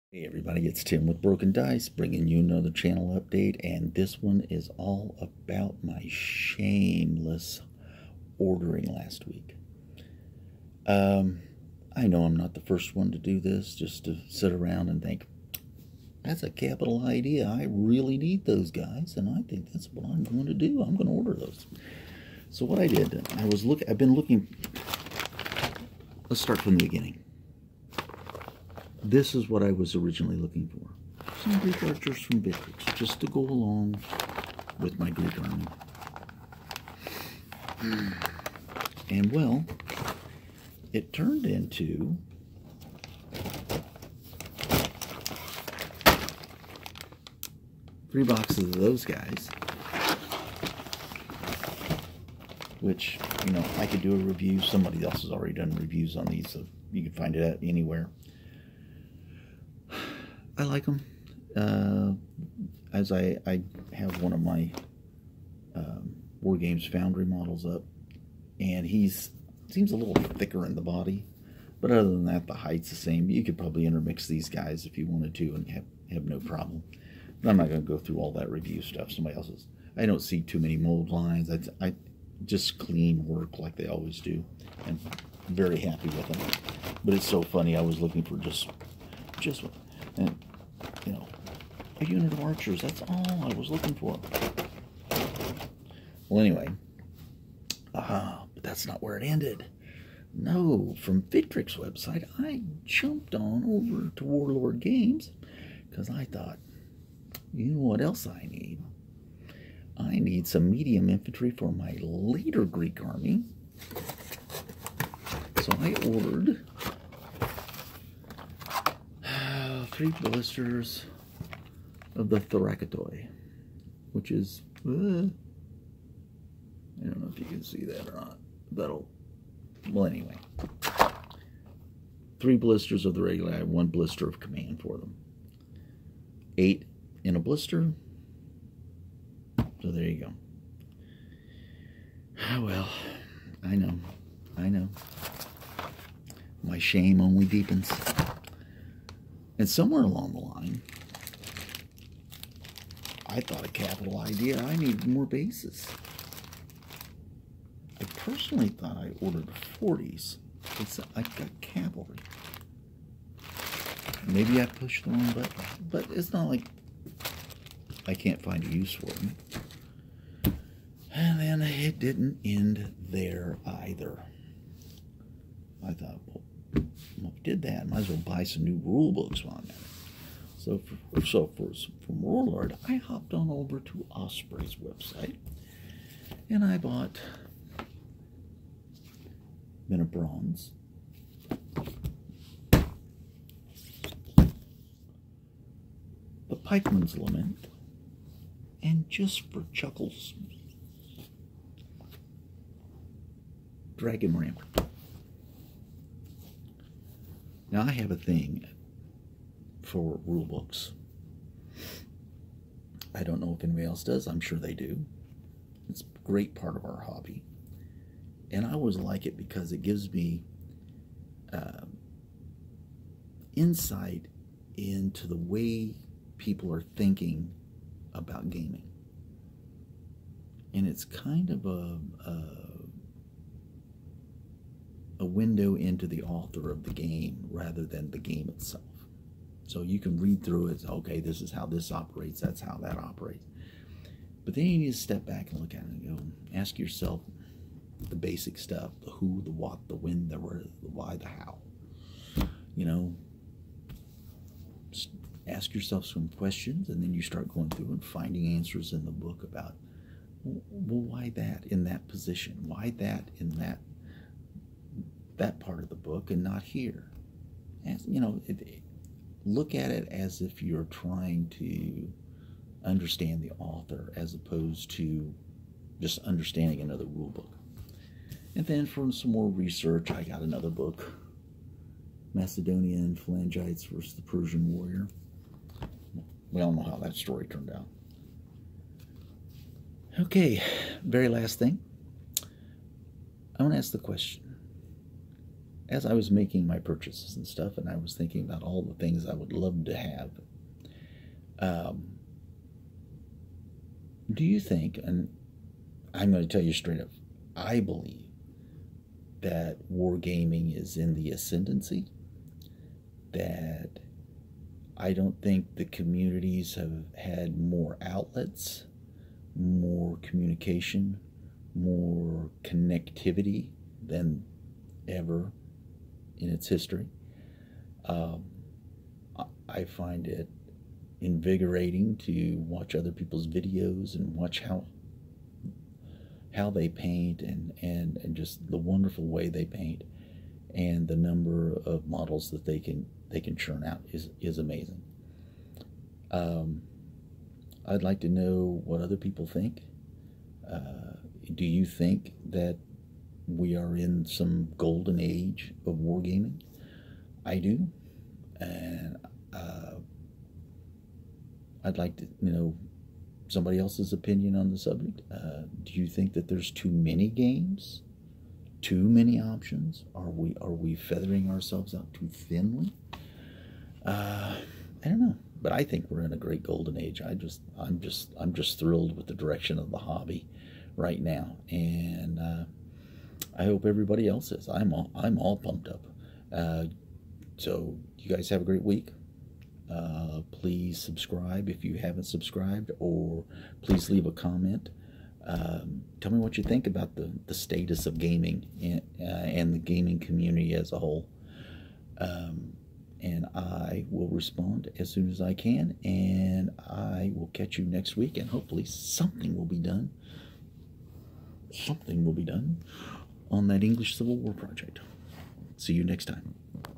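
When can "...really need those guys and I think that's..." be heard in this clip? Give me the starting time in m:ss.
0:17.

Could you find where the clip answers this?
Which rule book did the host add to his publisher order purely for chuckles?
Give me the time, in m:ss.
3:23.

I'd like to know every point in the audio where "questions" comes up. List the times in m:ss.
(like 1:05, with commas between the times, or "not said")
4:16, 4:53.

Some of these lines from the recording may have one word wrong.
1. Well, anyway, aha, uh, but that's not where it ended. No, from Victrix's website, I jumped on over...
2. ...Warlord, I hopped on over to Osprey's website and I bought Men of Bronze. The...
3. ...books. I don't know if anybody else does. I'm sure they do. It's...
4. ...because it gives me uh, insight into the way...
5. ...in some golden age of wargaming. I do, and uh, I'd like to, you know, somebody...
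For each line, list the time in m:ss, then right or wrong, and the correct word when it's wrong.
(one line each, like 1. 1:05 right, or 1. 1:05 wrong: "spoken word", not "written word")
1. 1:36 right
2. 3:02 right
3. 3:30 right
4. 3:39 right
5. 5:53 right.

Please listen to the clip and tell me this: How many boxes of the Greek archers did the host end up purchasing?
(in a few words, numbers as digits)
3.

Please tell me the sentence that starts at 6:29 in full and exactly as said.
Uh, please subscribe if you haven't subscribed, or please leave a comment.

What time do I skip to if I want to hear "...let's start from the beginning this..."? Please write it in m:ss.
0:26.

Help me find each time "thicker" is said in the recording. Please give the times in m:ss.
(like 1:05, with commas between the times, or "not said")
1:10.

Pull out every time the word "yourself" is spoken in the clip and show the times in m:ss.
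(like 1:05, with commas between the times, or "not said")
4:06, 4:15.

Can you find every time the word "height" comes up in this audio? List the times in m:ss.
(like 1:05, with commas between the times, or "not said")
1:12.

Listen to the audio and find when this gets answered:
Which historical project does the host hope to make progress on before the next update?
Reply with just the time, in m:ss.
6:53.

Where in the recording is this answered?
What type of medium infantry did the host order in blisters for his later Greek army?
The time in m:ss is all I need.
2:02.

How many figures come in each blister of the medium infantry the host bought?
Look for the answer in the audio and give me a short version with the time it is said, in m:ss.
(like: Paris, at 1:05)
8, at 2:16.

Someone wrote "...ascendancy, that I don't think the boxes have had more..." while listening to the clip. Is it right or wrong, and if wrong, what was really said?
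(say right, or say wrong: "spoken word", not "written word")
wrong: "communities", not "boxes".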